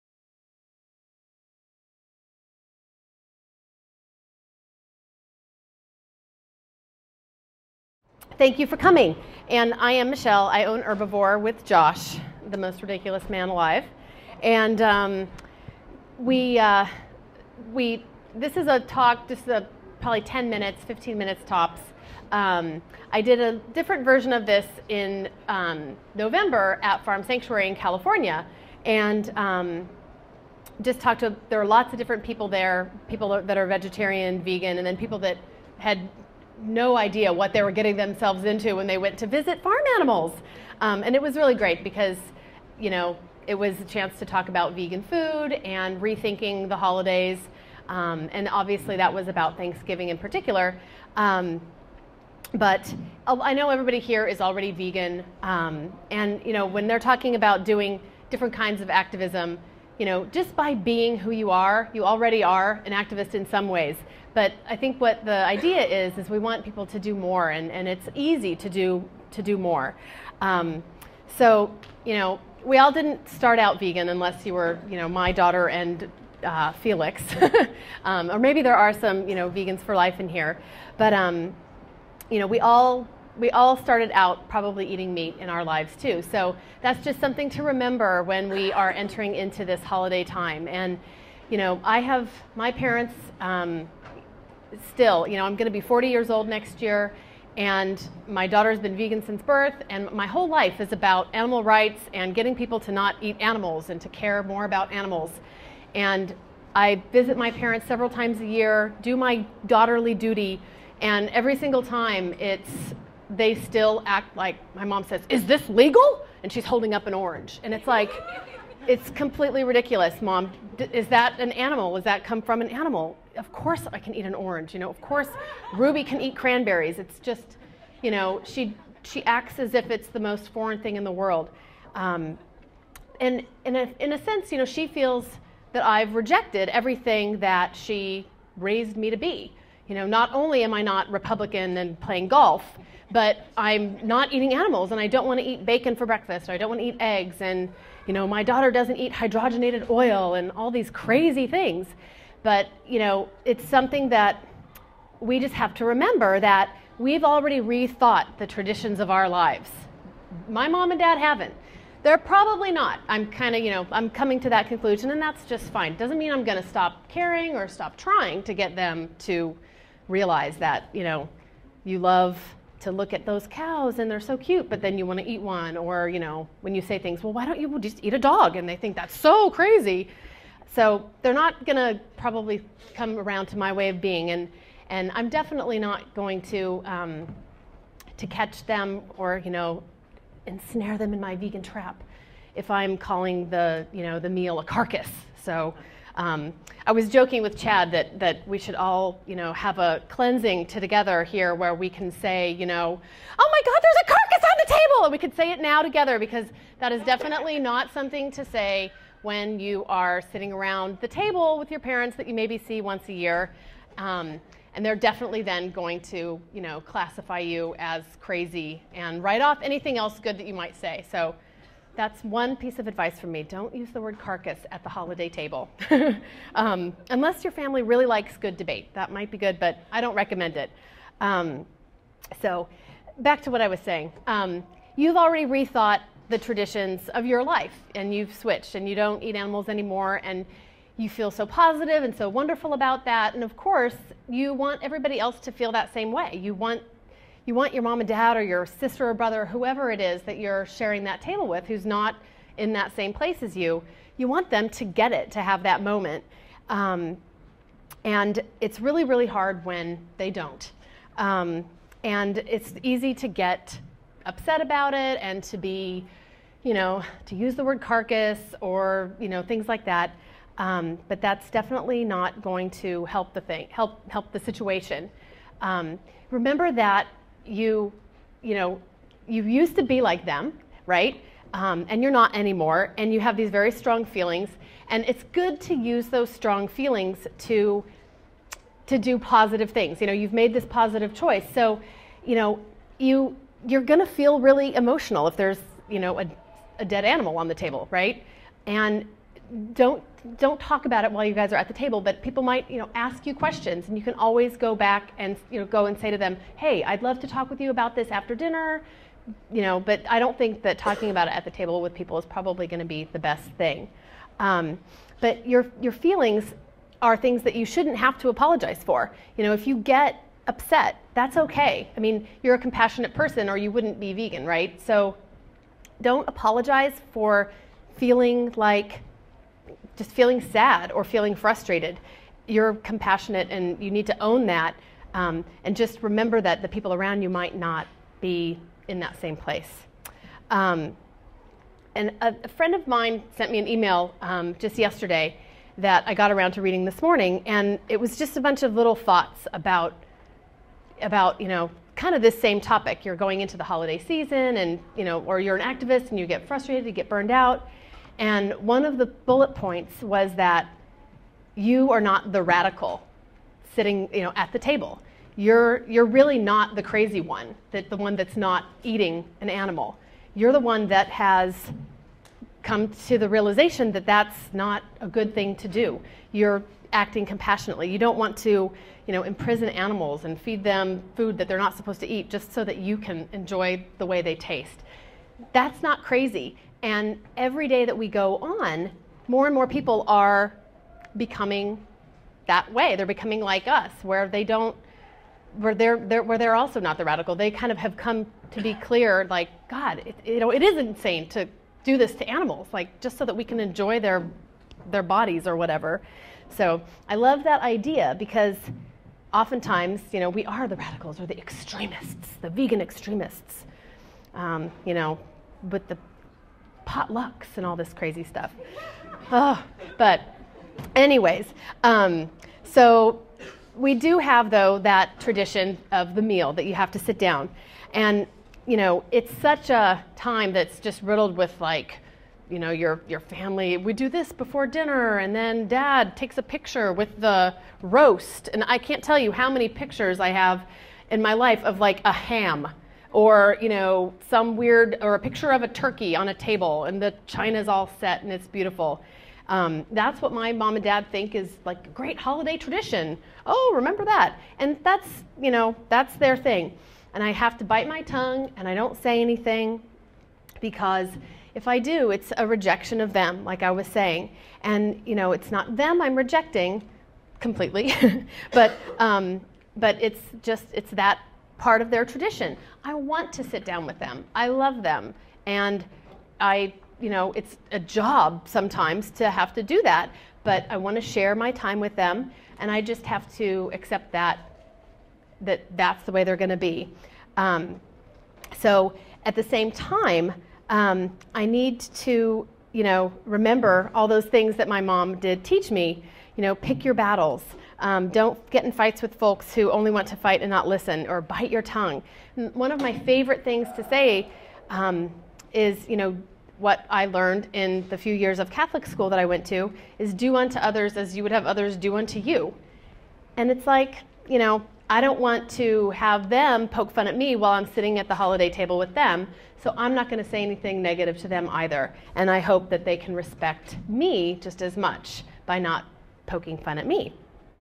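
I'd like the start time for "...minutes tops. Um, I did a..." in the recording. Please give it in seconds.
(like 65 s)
21 s.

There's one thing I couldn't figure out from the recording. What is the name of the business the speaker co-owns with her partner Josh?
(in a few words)
Herbivore.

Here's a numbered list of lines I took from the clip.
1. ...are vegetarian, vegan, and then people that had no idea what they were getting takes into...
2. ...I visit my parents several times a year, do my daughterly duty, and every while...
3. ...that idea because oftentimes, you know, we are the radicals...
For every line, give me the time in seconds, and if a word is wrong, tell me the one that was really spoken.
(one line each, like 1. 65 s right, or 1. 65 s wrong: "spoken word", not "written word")
1. 33 s wrong: "themselves", not "takes"
2. 106 s wrong: "single", not "while"
3. 407 s right.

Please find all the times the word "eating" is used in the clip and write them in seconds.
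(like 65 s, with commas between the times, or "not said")
84 s, 144 s, 368 s.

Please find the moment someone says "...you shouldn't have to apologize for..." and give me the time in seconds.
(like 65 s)
317 s.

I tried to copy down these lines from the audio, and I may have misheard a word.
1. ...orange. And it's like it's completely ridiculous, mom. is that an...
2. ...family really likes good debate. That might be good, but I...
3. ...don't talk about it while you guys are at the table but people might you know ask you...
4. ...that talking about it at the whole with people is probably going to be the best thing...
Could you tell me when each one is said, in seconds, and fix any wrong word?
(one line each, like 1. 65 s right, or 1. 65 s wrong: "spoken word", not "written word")
1. 117 s right
2. 227 s right
3. 300 s right
4. 310 s wrong: "table", not "whole".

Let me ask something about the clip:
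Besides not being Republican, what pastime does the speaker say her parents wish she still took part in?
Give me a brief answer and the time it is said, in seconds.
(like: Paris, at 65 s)
Golf, at 141 s.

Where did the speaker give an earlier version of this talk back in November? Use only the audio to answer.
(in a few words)
Farm Sanctuary.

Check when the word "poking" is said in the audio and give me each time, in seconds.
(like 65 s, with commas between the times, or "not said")
526 s.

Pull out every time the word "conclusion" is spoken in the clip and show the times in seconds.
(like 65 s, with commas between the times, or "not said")
164 s.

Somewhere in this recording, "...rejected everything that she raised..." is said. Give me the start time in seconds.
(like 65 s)
136 s.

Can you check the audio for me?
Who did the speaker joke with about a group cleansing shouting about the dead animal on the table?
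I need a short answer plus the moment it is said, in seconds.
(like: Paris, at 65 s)
Chad, at 197 s.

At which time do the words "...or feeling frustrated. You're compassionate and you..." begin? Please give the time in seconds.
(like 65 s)
330 s.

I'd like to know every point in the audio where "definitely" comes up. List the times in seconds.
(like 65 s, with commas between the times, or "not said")
185 s, 207 s, 214 s, 271 s.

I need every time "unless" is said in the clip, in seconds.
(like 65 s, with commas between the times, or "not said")
74 s, 227 s.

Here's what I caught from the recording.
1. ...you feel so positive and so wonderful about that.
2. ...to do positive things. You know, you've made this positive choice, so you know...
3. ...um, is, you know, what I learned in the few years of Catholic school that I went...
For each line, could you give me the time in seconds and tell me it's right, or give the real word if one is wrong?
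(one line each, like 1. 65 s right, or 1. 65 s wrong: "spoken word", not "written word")
1. 240 s right
2. 288 s right
3. 504 s right.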